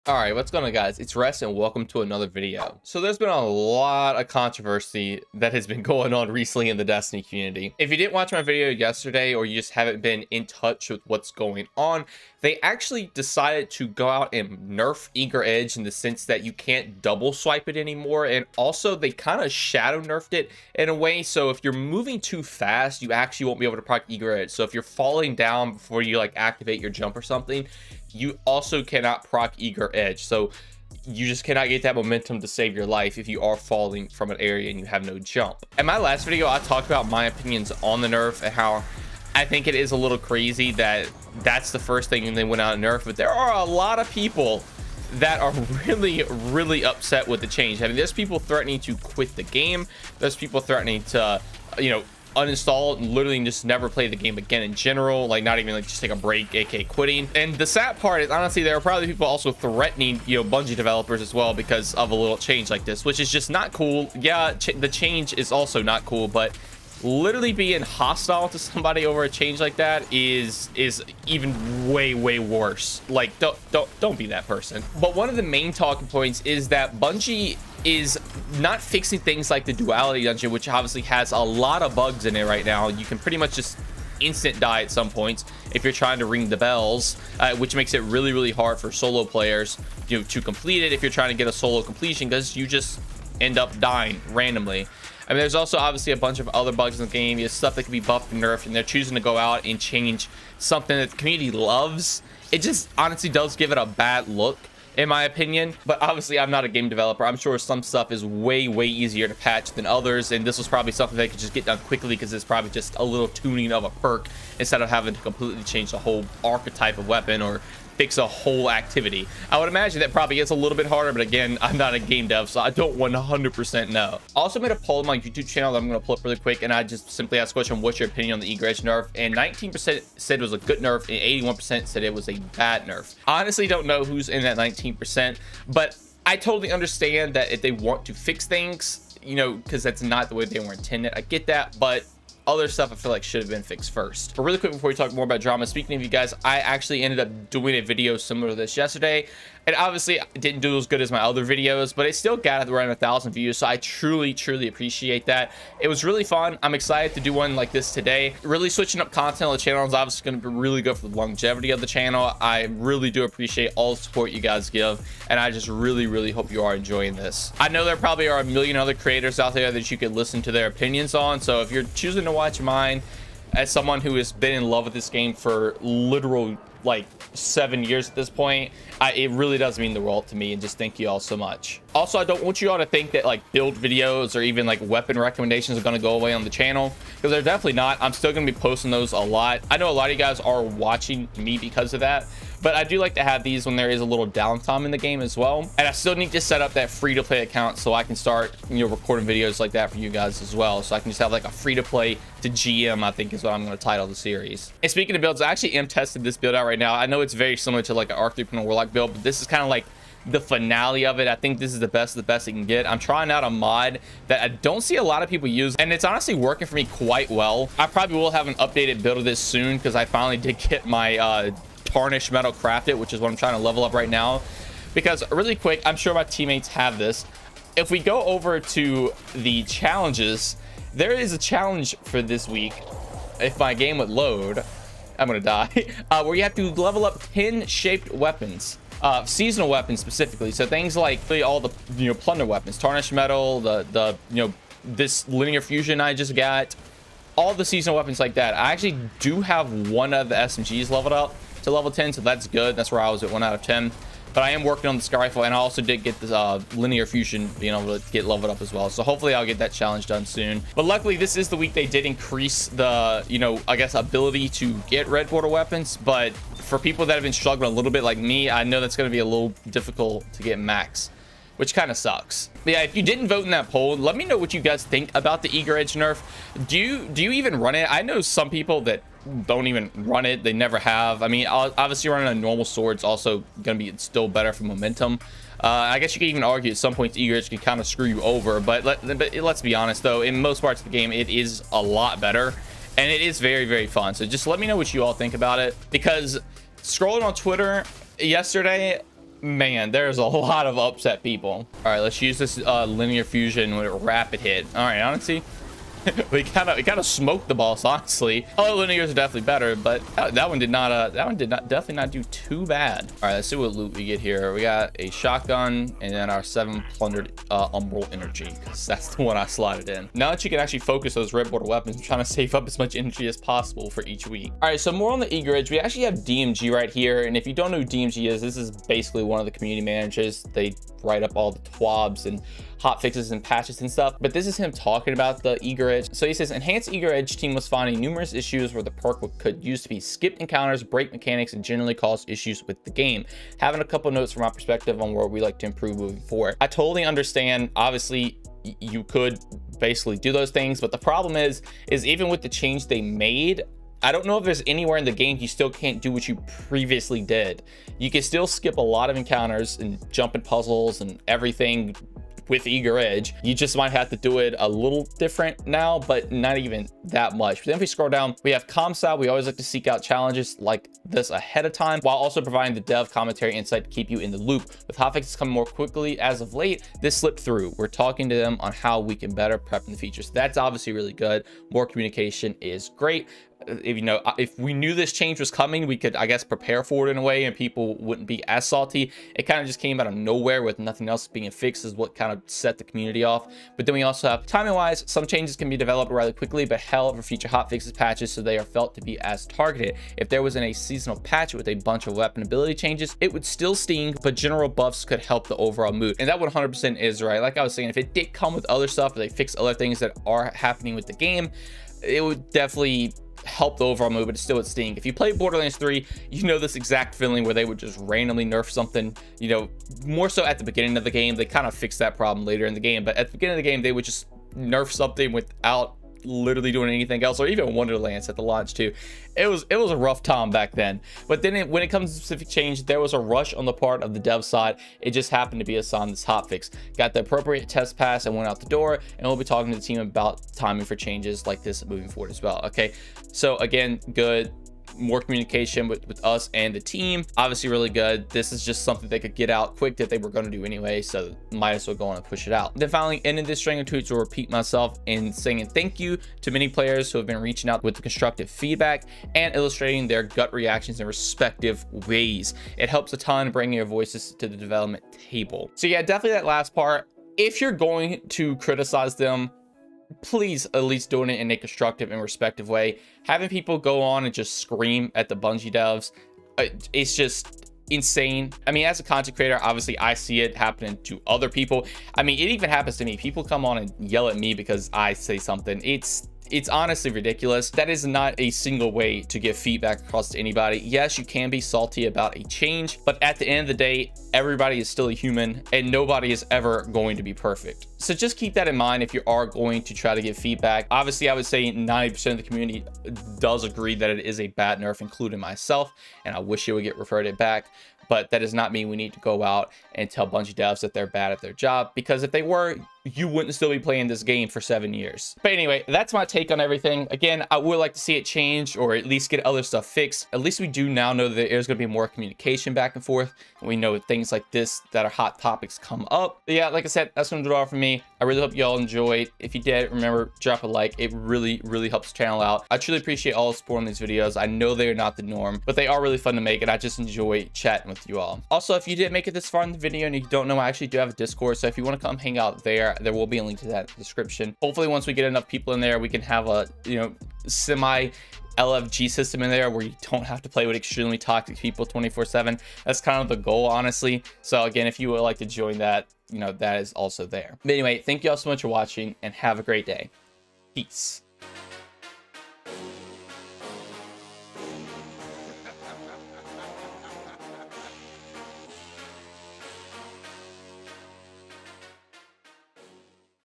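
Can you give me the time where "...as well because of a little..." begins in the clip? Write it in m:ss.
1:01.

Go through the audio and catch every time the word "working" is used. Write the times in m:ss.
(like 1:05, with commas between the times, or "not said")
3:36, 4:14.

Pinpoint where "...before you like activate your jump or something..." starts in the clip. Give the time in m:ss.
0:25.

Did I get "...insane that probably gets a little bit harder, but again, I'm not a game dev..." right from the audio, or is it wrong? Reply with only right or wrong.
wrong.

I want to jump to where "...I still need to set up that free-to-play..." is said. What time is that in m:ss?
3:15.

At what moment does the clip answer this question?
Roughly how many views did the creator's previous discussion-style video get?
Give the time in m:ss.
2:32.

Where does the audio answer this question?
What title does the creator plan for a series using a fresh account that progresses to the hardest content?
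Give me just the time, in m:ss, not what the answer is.
3:21.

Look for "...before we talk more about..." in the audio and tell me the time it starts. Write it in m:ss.
2:24.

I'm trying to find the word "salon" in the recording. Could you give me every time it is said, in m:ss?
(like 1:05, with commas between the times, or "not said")
not said.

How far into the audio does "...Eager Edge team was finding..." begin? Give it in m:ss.
5:36.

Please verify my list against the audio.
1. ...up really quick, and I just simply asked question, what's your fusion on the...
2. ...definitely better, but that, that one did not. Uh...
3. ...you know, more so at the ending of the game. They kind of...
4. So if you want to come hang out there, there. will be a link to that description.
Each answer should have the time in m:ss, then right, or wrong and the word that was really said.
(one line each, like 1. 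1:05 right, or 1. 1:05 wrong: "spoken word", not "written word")
1. 2:06 wrong: "opinion", not "fusion"
2. 5:09 right
3. 6:59 wrong: "beginning", not "ending"
4. 9:01 right.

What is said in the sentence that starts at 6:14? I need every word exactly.
With hotfixes coming more quickly as of late, this slipped through.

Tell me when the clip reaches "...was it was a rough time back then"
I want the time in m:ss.
7:09.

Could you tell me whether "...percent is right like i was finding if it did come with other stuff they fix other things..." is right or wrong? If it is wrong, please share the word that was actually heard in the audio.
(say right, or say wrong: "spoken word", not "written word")
wrong: "saying", not "finding".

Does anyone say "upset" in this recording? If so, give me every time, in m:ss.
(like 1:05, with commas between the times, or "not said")
0:46, 5:00.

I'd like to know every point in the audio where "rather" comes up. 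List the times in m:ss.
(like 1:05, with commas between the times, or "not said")
6:36.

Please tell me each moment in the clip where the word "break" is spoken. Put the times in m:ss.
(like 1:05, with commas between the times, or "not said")
0:56, 5:40.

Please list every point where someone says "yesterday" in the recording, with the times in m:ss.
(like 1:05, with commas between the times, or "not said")
0:08, 2:28, 4:58.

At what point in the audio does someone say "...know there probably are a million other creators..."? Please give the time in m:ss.
2:47.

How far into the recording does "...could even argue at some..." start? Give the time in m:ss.
4:46.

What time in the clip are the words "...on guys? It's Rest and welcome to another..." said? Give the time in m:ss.
0:00.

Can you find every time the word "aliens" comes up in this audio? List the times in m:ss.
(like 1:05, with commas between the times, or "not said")
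not said.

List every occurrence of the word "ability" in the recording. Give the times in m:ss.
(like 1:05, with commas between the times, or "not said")
4:23, 6:42.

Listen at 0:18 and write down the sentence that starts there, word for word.
And also they kind of shadow nerfed it in a way.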